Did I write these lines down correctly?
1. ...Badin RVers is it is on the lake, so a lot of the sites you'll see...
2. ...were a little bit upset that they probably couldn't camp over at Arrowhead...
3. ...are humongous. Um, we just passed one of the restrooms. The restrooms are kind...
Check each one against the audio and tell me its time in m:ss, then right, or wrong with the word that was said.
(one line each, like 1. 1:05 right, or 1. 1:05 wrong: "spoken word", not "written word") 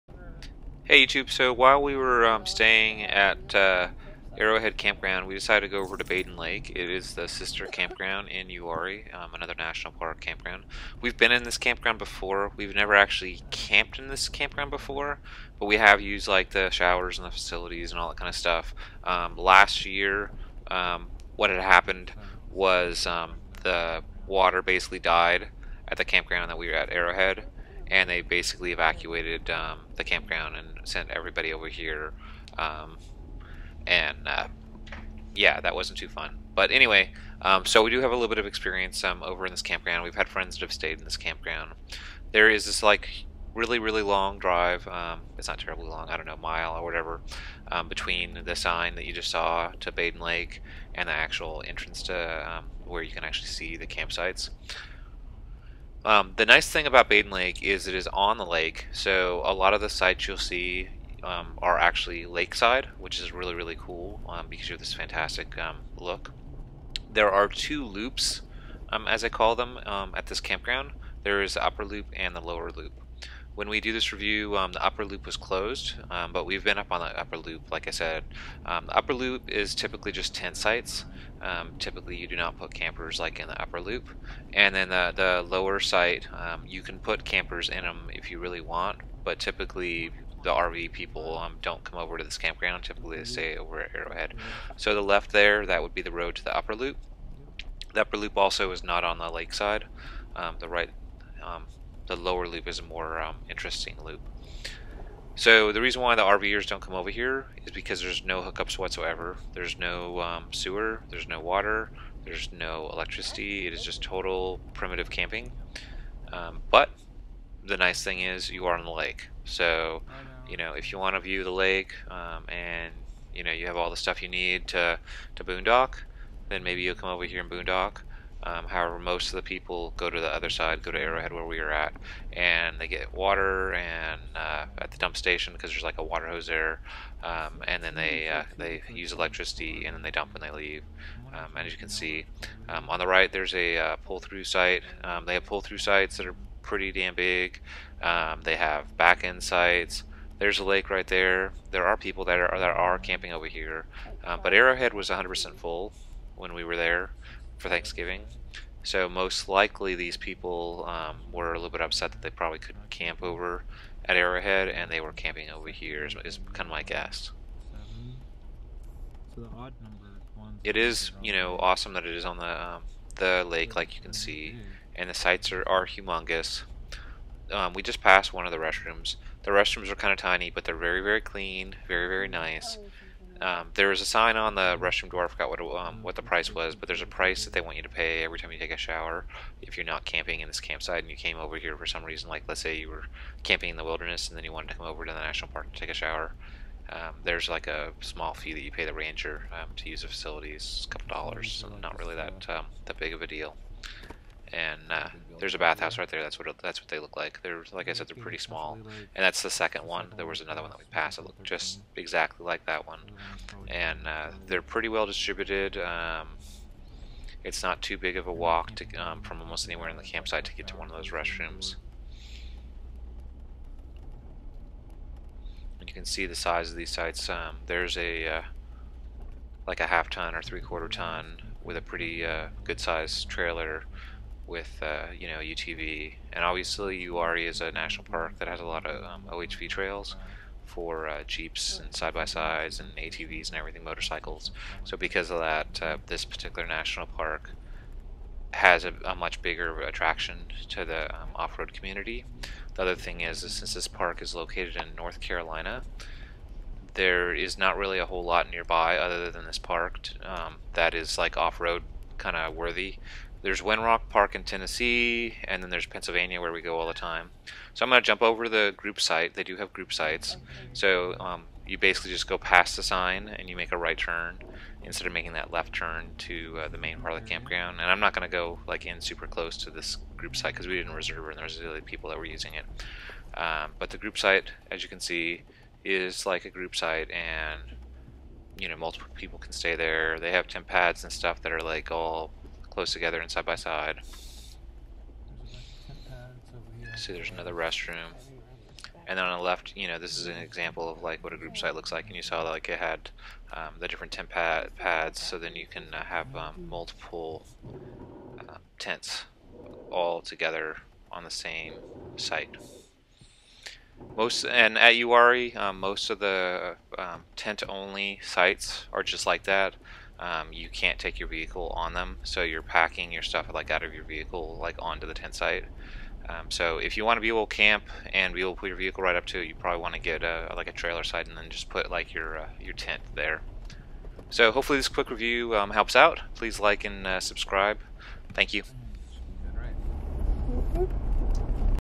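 1. 0:57 wrong: "Lake", not "RVers"
2. 2:41 right
3. 2:55 right.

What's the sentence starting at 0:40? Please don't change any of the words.
We've had friends that have stayed in this campground.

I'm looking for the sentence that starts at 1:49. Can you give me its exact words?
There's no um, sewer, there's no water, there's no electricity.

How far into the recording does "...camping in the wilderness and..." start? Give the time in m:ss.
3:13.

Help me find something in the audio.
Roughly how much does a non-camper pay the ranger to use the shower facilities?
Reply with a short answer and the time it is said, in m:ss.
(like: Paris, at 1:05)
A couple dollars, at 3:20.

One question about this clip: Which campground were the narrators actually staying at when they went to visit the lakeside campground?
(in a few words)
Arrowhead Campground.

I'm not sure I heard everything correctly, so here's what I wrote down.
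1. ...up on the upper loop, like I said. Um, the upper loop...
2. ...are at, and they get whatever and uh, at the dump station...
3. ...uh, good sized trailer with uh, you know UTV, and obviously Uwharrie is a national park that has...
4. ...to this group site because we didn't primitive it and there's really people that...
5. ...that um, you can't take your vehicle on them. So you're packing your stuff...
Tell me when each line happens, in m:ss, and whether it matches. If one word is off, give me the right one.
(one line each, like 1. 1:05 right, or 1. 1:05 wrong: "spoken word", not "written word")
1. 1:16 right
2. 2:11 wrong: "water", not "whatever"
3. 3:52 right
4. 4:39 wrong: "reserve", not "primitive"
5. 5:19 right.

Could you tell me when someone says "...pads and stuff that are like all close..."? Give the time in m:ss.
4:50.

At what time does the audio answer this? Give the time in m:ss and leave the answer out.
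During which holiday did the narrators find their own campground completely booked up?
2:37.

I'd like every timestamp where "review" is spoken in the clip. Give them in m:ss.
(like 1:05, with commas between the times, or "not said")
1:14, 5:35.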